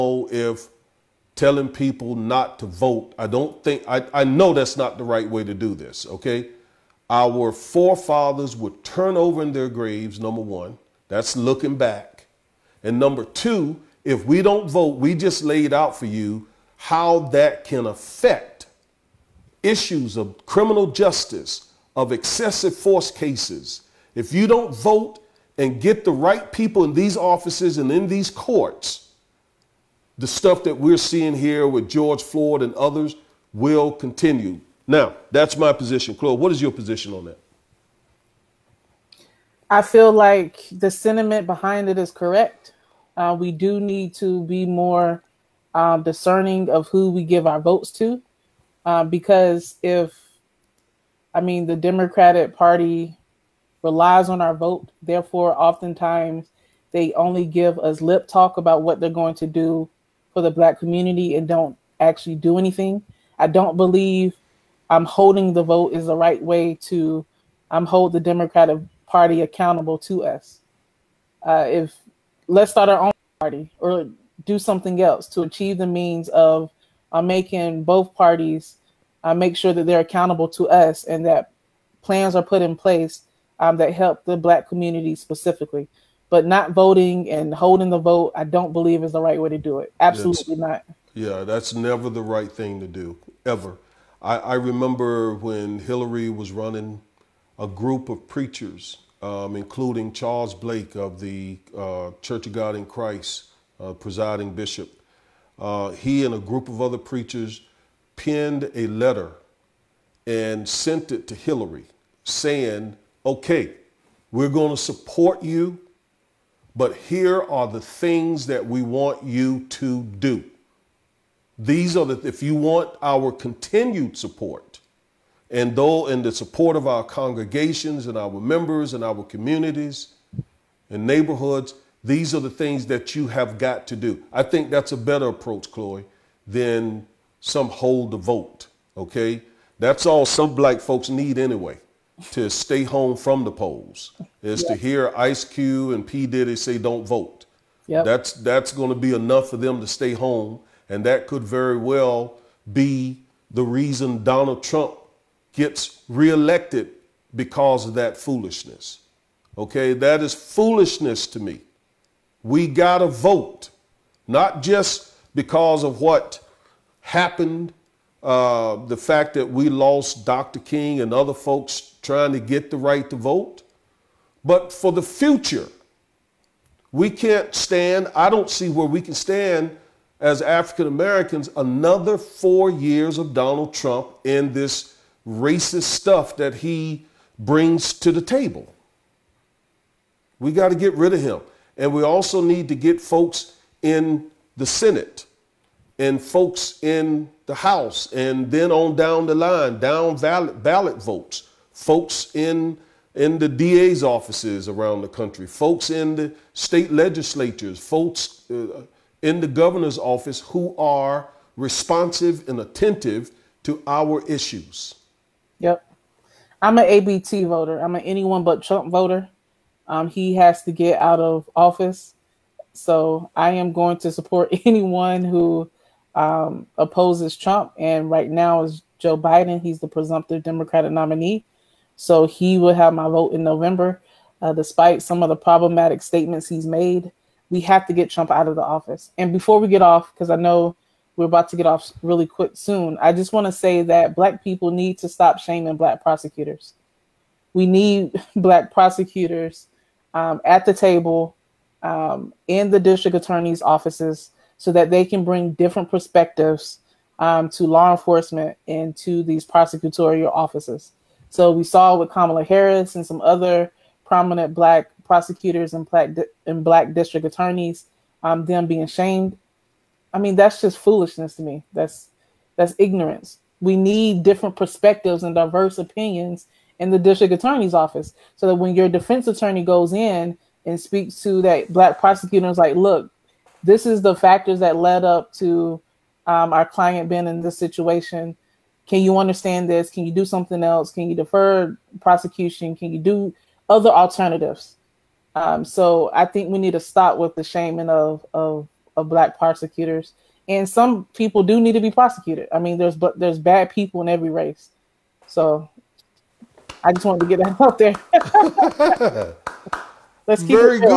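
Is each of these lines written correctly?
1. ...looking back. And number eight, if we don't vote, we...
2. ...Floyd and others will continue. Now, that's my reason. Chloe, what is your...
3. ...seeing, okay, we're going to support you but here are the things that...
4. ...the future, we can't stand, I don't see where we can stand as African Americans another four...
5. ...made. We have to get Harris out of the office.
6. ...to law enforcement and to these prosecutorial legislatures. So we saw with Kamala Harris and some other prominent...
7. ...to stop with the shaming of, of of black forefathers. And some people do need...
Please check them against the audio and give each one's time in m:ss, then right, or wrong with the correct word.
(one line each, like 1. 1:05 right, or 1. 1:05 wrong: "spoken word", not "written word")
1. 0:11 wrong: "two", not "eight"
2. 0:32 wrong: "position", not "reason"
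3. 1:52 wrong: "saying", not "seeing"
4. 2:54 right
5. 3:56 wrong: "Trump", not "Harris"
6. 4:17 wrong: "offices", not "legislatures"
7. 4:56 wrong: "prosecutors", not "forefathers".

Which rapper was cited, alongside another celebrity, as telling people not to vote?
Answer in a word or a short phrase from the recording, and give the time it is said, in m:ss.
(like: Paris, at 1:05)
Ice Cube, at 2:25.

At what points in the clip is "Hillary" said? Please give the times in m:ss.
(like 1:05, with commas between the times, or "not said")
1:35, 1:51.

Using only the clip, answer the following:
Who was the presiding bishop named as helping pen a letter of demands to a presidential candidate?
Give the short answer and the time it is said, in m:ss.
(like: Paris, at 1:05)
Charles Blake, at 1:40.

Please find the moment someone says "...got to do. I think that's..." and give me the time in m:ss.
2:13.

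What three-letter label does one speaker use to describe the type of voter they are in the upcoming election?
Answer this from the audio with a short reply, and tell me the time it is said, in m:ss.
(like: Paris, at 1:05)
ABT, at 3:36.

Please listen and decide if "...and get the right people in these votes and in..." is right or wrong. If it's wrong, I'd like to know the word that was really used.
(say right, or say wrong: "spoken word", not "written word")
wrong: "offices", not "votes".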